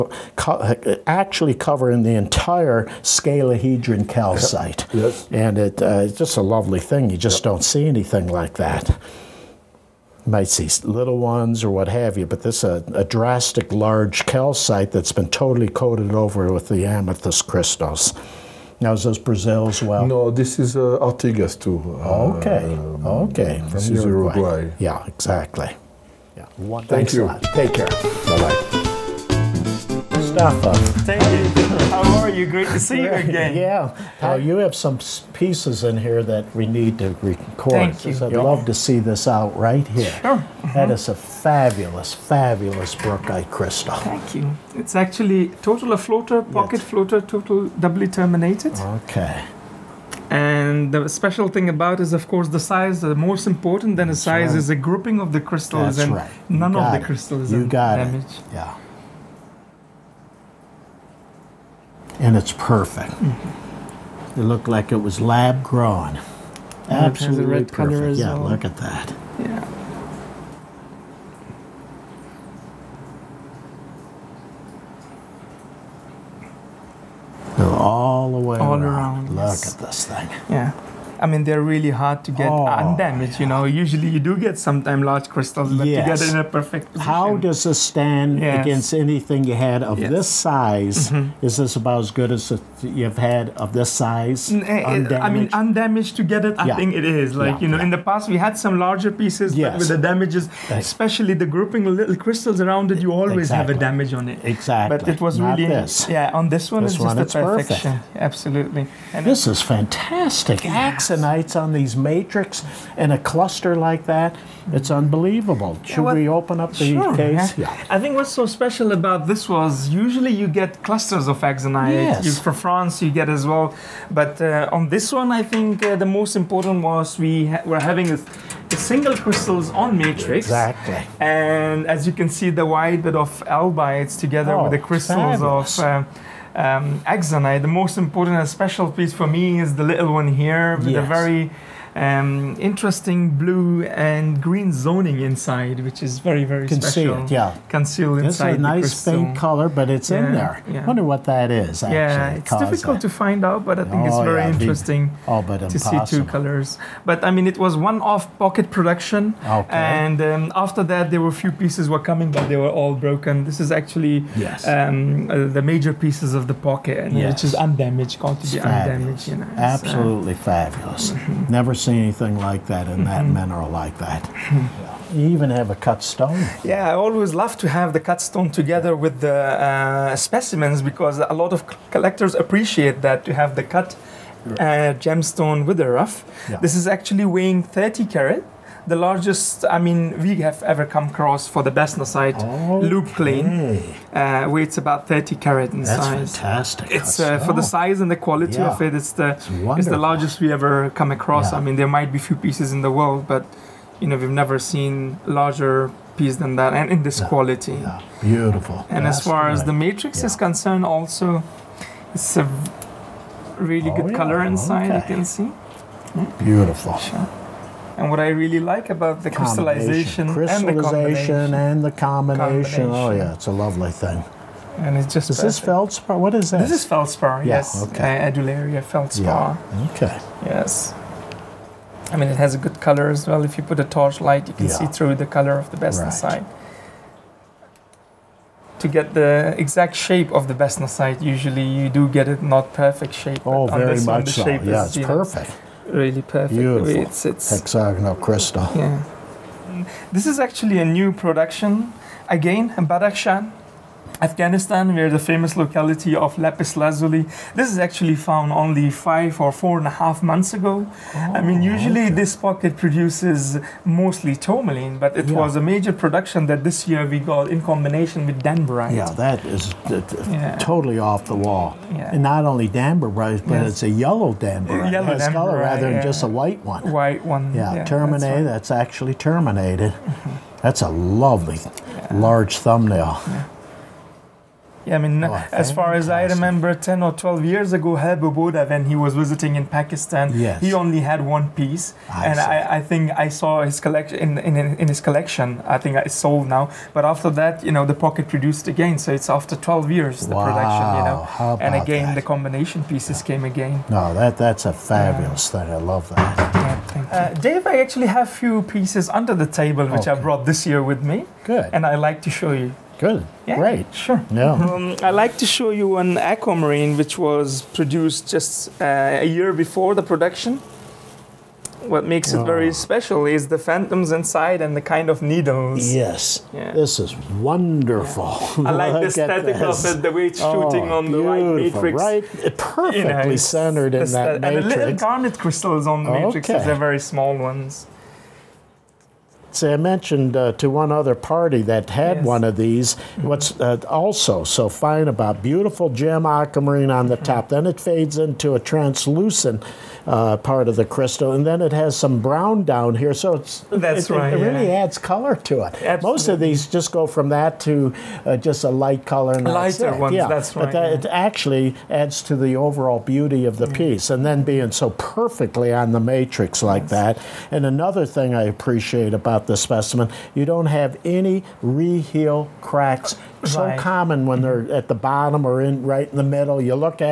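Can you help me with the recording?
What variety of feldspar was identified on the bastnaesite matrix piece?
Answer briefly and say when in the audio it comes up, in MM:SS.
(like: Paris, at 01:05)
Adularia, at 03:48.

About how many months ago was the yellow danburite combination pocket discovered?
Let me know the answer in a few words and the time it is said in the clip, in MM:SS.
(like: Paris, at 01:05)
4.5 months, at 04:19.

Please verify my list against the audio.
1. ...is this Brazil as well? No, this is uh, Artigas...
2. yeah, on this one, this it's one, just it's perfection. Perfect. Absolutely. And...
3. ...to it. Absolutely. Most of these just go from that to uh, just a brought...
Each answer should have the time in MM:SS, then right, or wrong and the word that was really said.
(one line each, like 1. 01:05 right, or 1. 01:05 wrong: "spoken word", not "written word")
1. 00:18 right
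2. 01:46 right
3. 05:55 wrong: "light", not "brought".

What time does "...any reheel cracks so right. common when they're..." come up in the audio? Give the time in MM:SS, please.
06:11.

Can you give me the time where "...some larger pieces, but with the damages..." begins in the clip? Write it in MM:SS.
01:38.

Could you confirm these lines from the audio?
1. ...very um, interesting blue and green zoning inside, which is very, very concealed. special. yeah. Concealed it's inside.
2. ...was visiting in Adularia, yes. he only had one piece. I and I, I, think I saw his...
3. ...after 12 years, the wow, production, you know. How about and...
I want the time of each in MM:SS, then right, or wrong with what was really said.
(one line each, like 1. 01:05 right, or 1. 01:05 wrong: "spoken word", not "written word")
1. 02:21 right
2. 04:48 wrong: "Pakistan", not "Adularia"
3. 04:59 right.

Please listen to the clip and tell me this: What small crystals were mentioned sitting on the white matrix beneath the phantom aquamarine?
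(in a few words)
Garnet.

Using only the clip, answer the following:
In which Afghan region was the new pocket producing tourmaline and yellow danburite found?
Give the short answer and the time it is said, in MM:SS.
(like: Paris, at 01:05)
Badakhshan, at 04:12.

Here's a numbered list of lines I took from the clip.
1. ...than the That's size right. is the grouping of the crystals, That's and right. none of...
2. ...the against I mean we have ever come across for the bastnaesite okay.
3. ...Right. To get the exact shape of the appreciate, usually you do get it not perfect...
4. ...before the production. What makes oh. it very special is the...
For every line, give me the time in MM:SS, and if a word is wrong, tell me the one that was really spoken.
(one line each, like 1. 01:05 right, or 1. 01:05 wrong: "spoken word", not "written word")
1. 00:53 right
2. 03:08 wrong: "largest", not "against"
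3. 03:56 wrong: "bastnaesite", not "appreciate"
4. 05:19 right.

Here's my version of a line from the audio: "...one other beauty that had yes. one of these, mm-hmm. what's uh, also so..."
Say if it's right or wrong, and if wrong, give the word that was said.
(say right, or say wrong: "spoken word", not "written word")
wrong: "party", not "beauty".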